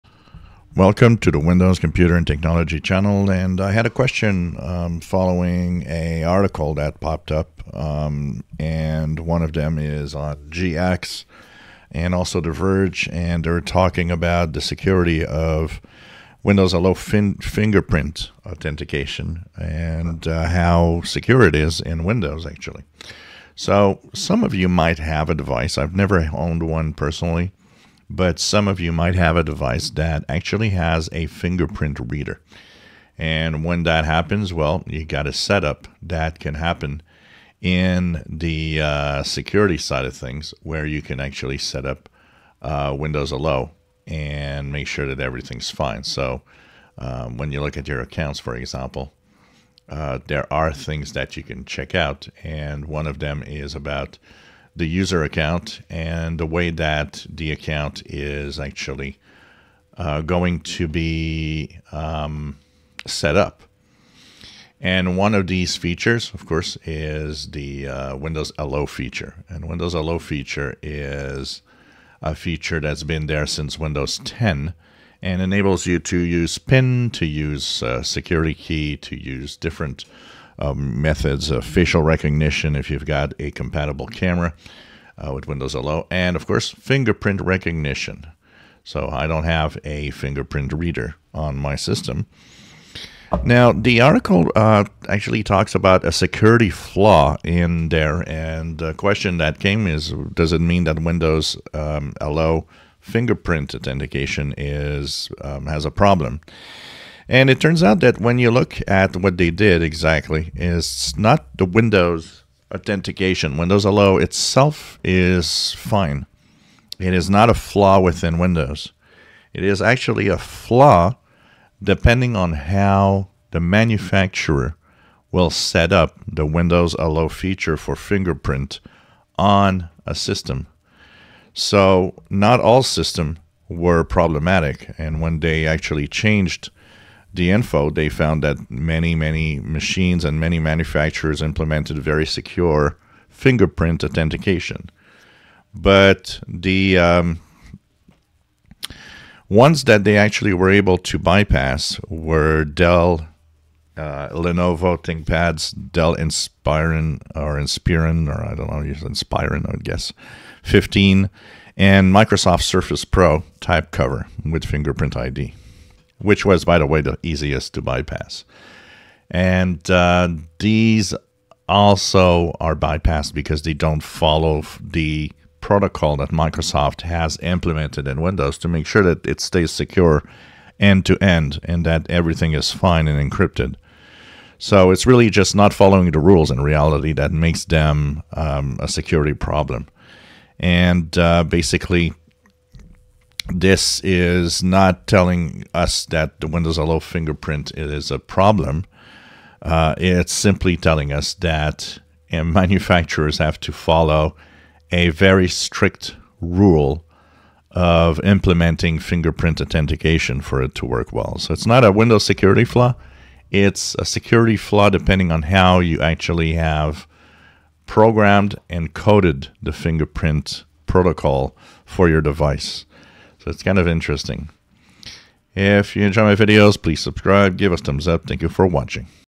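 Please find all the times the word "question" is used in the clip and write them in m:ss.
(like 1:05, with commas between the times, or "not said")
0:03, 1:38.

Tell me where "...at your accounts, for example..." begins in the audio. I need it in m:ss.
0:47.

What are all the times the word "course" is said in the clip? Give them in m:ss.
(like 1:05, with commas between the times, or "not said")
1:06, 1:26.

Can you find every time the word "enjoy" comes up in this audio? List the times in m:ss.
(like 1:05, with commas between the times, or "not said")
3:46.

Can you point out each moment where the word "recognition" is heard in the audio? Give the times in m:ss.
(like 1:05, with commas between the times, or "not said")
1:22, 1:27.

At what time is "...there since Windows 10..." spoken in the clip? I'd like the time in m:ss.
1:13.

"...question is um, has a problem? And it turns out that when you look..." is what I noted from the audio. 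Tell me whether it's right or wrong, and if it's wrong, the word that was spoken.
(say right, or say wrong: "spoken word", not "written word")
wrong: "authentication", not "question".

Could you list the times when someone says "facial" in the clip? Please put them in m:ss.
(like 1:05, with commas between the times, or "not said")
1:21.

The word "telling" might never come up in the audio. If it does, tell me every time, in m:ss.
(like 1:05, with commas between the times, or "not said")
3:15, 3:20.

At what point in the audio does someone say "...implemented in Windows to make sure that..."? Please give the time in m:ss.
2:57.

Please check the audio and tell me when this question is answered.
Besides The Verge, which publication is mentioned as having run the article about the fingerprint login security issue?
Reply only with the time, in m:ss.
0:10.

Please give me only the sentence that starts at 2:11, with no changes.
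So not all systems were problematic.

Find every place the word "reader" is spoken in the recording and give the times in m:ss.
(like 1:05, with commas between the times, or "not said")
0:32, 1:30.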